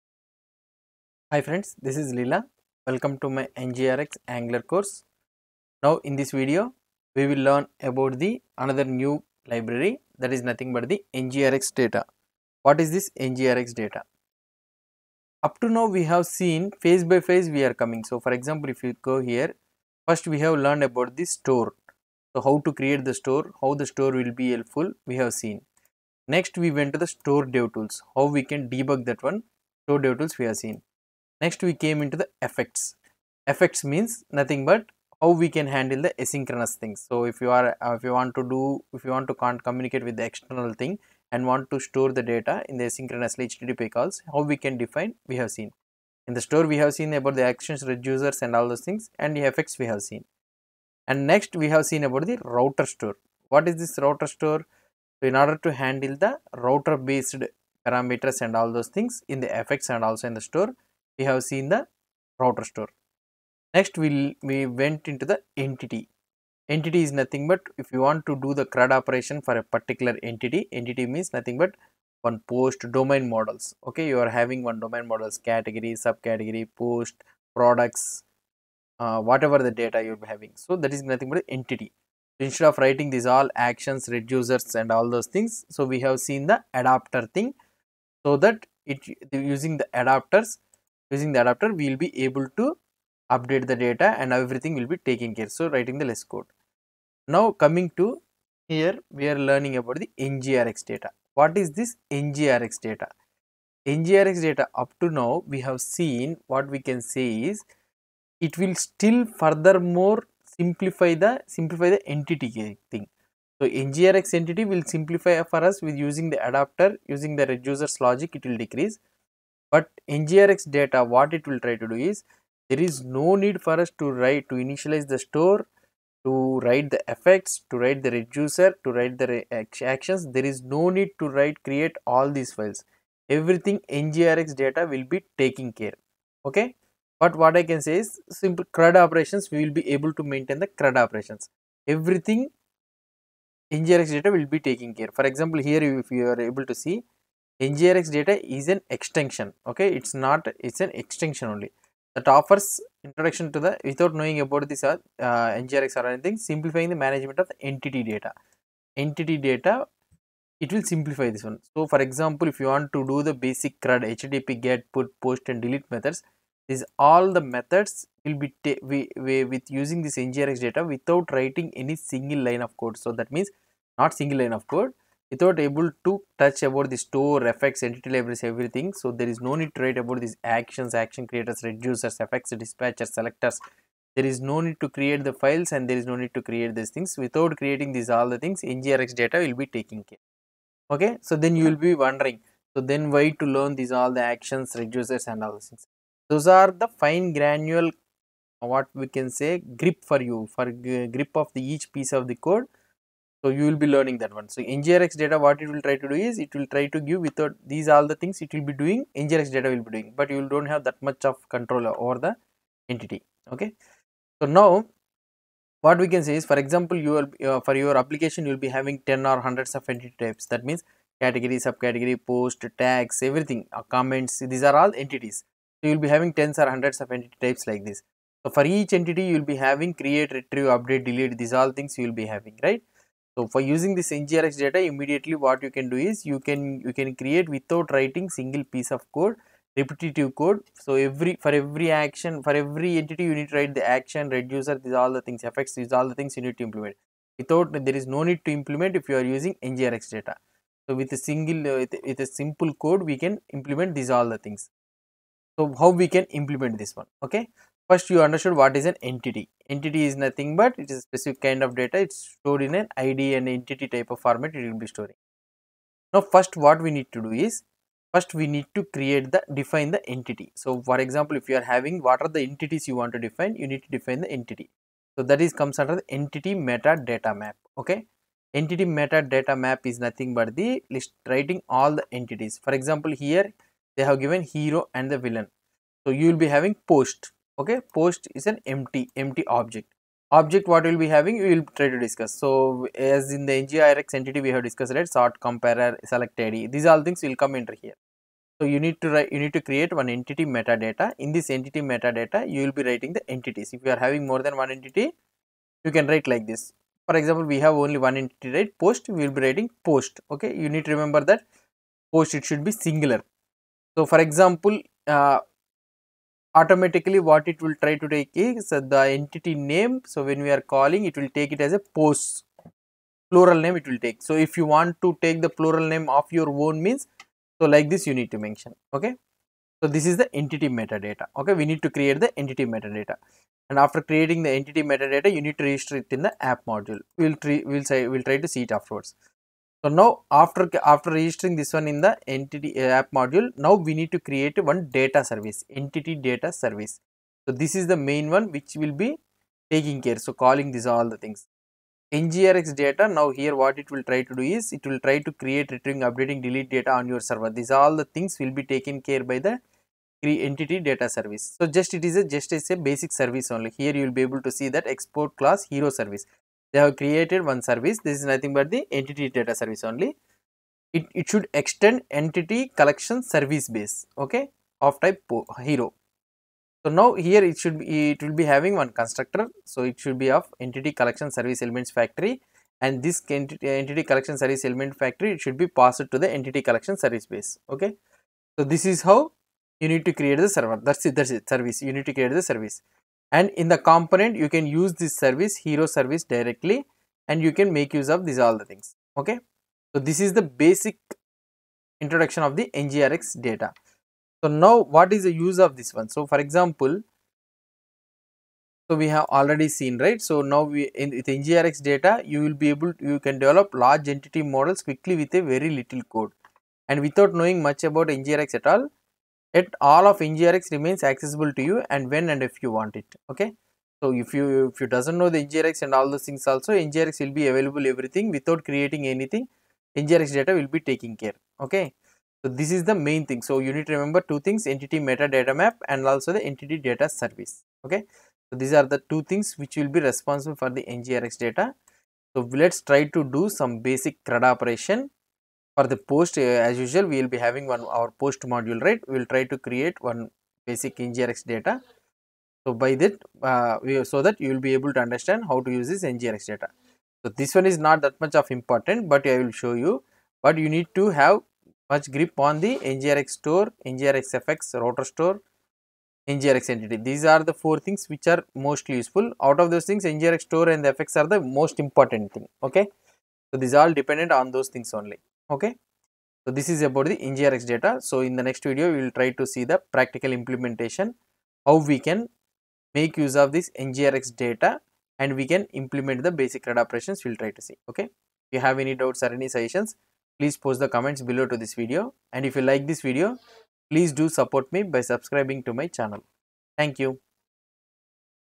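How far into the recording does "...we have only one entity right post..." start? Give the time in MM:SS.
05:07.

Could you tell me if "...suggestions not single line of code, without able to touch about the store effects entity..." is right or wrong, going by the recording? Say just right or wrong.
wrong.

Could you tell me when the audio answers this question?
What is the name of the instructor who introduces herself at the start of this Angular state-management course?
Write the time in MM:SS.
00:02.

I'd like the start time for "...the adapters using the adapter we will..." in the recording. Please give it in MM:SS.
01:29.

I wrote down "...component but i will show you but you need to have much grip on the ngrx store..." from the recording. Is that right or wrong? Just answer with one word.
wrong.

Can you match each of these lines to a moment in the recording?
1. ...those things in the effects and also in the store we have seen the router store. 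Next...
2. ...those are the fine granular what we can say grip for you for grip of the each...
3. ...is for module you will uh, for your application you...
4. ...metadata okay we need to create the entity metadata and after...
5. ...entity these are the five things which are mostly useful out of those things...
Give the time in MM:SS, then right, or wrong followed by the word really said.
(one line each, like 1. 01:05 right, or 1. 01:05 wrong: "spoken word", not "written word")
1. 00:58 right
2. 03:16 right
3. 03:36 wrong: "example", not "module"
4. 05:30 right
5. 07:46 wrong: "four", not "five".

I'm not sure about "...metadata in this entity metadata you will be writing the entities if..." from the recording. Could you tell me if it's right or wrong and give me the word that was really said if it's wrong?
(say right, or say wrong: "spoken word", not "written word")
right.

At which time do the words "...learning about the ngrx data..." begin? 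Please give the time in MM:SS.
01:39.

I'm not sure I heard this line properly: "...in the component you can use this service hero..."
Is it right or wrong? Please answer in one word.
right.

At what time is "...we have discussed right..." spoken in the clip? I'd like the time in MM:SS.
04:54.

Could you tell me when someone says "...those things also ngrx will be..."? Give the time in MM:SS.
07:06.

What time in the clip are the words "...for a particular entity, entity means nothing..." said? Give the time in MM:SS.
01:09.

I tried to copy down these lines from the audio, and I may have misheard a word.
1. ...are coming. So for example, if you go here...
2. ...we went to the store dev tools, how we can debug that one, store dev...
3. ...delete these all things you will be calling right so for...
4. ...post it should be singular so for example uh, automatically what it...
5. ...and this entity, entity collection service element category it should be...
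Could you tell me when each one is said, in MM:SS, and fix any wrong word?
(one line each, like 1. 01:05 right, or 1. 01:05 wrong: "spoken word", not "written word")
1. 00:17 right
2. 00:26 right
3. 03:51 wrong: "having", not "calling"
4. 05:12 right
5. 06:22 wrong: "factory", not "category".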